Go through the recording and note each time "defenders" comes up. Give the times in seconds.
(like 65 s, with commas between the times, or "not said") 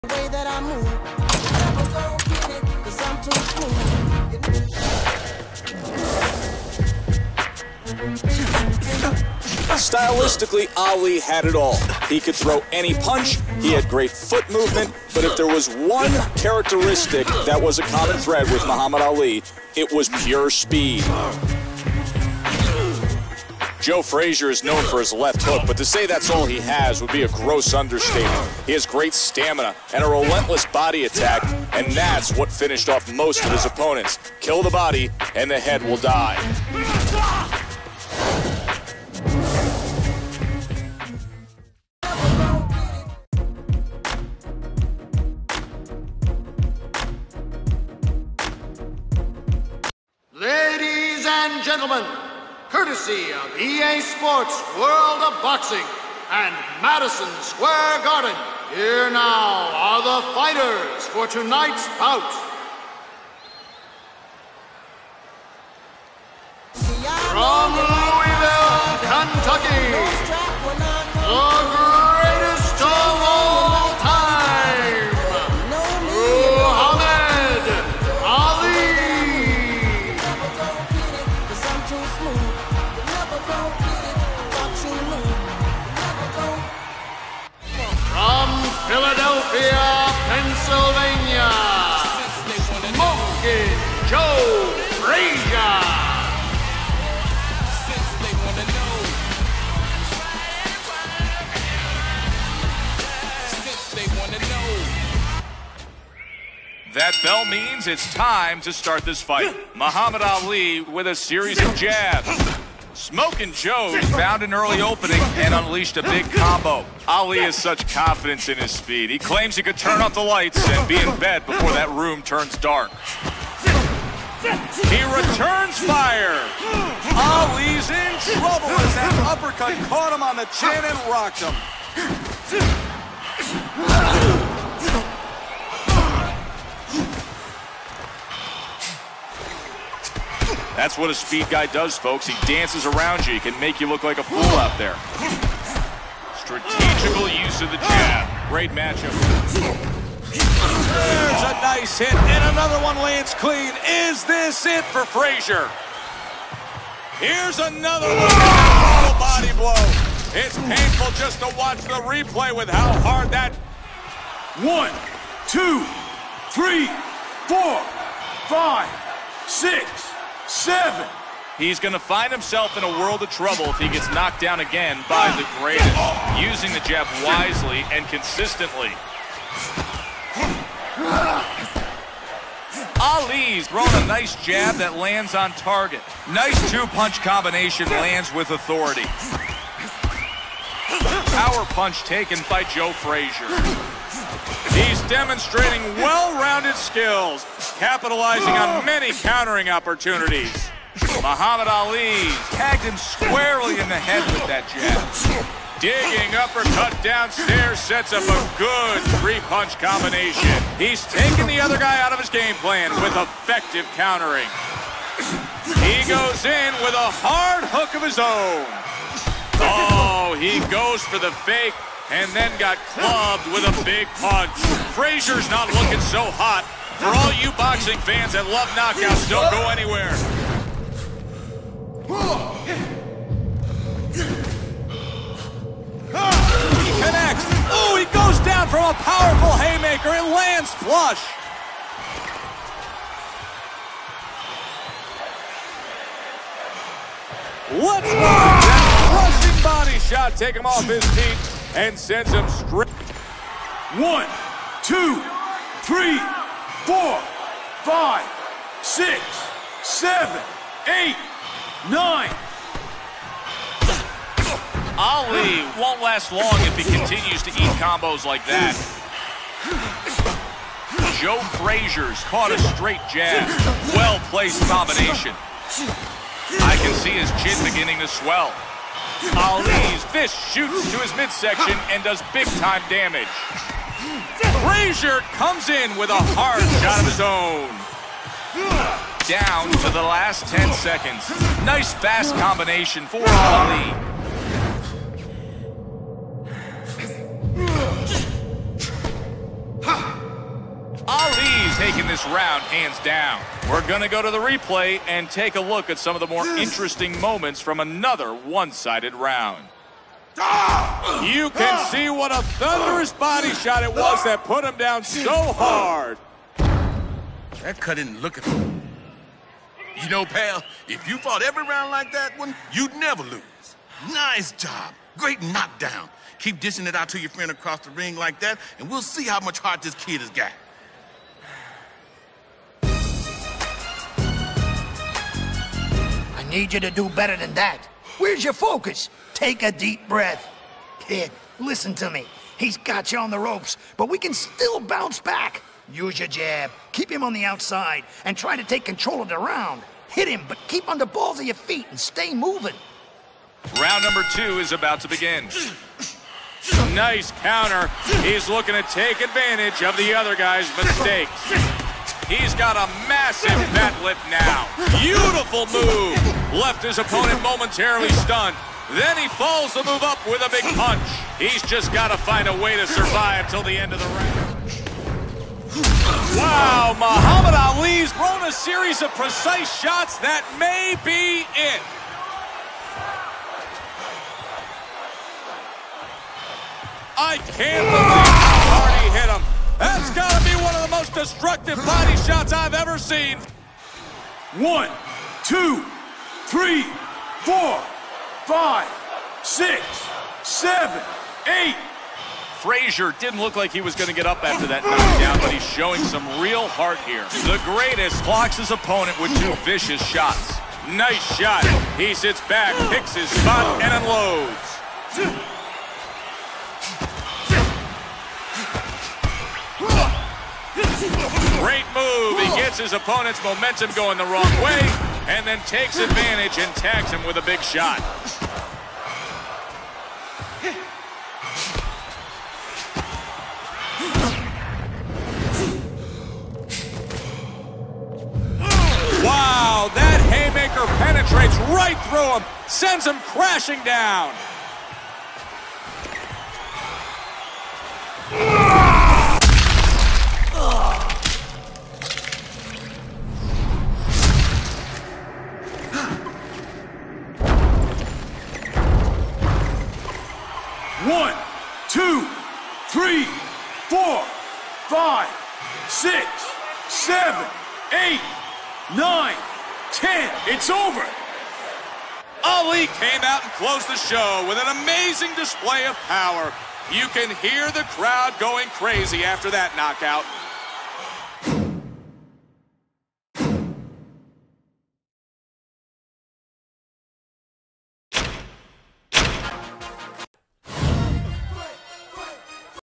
not said.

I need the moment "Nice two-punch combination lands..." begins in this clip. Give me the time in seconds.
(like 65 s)
186 s.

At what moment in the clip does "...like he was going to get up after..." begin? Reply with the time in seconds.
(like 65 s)
403 s.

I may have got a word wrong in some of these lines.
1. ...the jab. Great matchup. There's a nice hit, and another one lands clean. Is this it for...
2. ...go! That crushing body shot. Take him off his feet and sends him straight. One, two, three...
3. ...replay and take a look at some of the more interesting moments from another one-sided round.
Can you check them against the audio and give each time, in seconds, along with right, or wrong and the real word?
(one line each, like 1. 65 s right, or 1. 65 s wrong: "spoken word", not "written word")
1. 147 s right
2. 248 s right
3. 304 s right.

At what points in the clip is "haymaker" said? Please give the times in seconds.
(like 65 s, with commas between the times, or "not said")
239 s, 440 s.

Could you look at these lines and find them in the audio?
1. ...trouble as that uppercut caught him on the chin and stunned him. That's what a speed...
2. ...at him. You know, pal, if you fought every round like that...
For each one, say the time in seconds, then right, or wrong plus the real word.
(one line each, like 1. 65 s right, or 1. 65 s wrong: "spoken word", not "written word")
1. 128 s wrong: "rocked", not "stunned"
2. 318 s right.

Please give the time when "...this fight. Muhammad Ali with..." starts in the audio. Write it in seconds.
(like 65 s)
109 s.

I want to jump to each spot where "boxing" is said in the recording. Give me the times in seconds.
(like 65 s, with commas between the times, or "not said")
55 s, 227 s.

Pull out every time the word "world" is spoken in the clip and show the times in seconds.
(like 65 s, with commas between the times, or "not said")
54 s, 172 s.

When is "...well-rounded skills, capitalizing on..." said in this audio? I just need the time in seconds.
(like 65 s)
196 s.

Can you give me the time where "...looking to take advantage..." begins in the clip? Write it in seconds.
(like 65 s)
358 s.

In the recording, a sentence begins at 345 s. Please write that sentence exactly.
Use your jab, keep him on the outside, and try to take control of the round.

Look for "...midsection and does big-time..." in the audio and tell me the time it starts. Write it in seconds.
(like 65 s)
281 s.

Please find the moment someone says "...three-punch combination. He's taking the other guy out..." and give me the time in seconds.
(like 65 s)
209 s.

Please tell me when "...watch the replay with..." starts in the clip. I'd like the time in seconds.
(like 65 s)
161 s.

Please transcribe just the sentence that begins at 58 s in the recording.
Here now are the fighters for tonight's bout.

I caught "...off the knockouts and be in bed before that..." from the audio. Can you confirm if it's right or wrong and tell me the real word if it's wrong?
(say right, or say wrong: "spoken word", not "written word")
wrong: "lights", not "knockouts".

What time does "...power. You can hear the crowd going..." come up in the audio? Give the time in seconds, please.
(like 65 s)
476 s.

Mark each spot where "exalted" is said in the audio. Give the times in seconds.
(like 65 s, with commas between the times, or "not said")
not said.